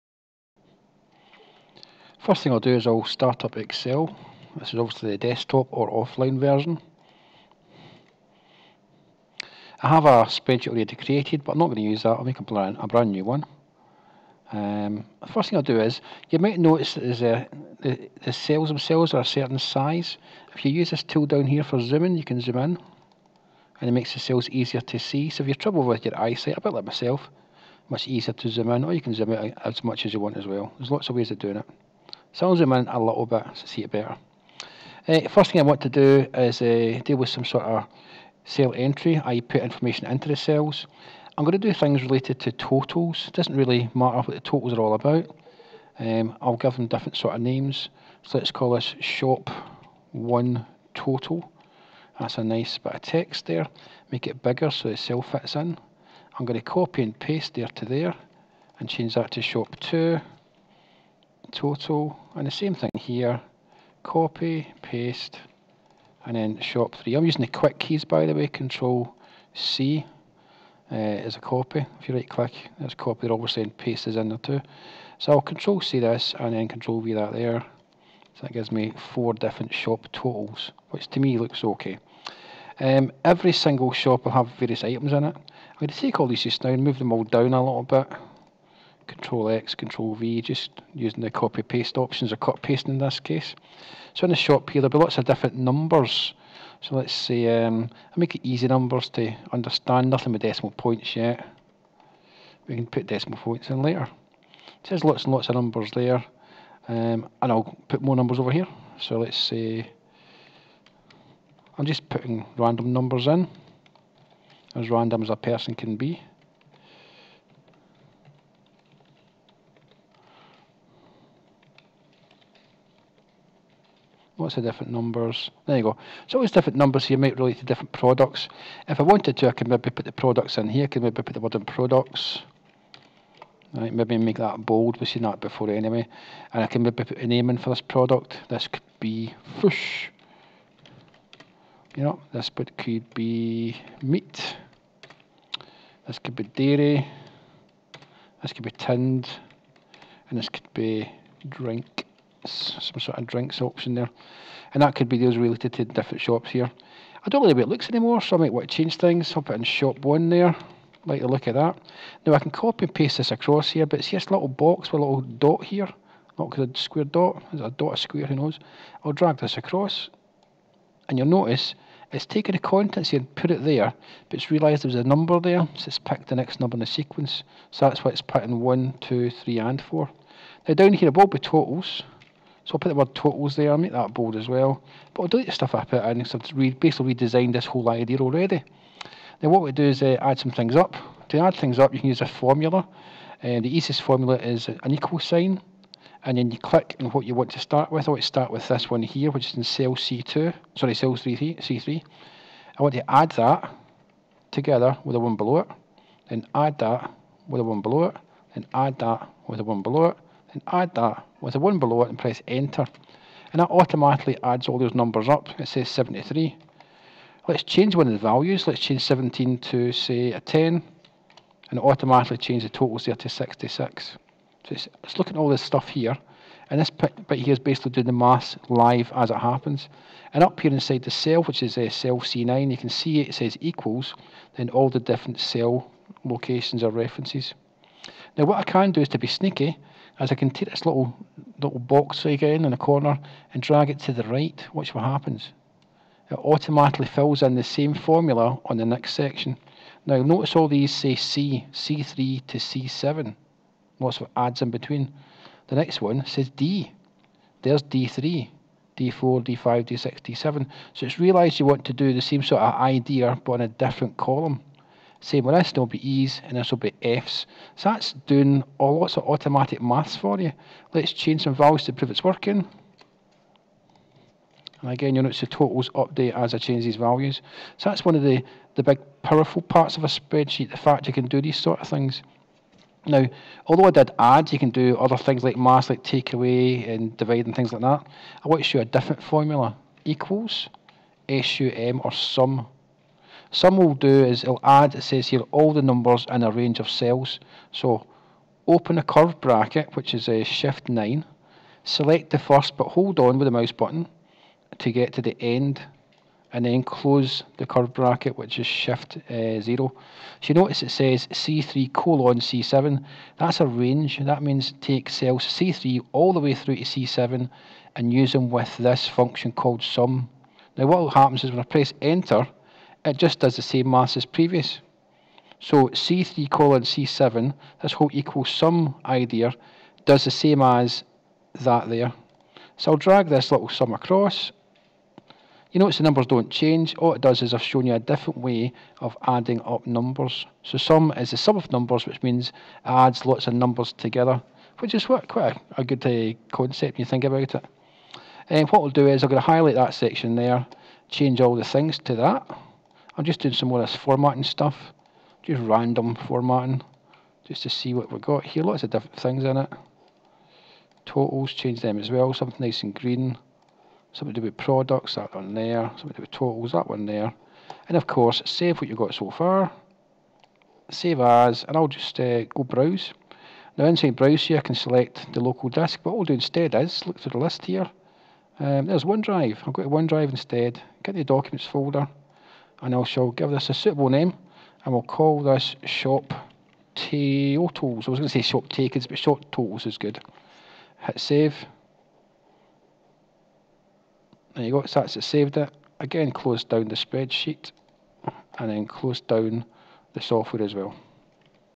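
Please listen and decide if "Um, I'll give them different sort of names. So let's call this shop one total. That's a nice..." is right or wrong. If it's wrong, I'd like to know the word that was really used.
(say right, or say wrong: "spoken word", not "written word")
right.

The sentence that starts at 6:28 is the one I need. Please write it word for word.
I was going to say shop takers, but shop totals is good.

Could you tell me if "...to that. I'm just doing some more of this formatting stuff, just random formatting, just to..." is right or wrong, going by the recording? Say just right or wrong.
right.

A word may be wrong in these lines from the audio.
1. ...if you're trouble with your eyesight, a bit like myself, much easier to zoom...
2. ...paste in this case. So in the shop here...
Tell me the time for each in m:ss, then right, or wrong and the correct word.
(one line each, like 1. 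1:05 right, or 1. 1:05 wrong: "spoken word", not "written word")
1. 0:25 right
2. 1:32 right.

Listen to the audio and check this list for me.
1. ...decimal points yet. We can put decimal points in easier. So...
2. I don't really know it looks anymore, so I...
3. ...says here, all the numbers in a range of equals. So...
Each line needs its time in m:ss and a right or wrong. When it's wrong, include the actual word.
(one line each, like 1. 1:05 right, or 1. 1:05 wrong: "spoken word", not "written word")
1. 1:40 wrong: "later", not "easier"
2. 2:37 right
3. 4:55 wrong: "cells", not "equals".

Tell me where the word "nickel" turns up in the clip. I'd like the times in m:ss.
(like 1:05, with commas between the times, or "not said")
not said.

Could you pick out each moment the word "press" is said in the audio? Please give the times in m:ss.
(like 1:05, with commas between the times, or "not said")
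3:32, 5:21.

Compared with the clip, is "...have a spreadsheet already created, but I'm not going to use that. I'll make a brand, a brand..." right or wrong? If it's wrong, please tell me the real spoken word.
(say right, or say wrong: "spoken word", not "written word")
right.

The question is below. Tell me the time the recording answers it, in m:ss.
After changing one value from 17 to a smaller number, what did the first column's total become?
3:43.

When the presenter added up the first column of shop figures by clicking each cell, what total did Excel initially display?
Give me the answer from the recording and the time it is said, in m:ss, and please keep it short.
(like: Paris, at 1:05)
73, at 3:35.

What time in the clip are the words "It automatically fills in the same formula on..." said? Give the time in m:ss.
4:06.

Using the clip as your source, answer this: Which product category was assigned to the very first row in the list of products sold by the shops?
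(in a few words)
Fish.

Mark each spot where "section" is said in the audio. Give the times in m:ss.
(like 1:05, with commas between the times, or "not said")
4:09, 5:49.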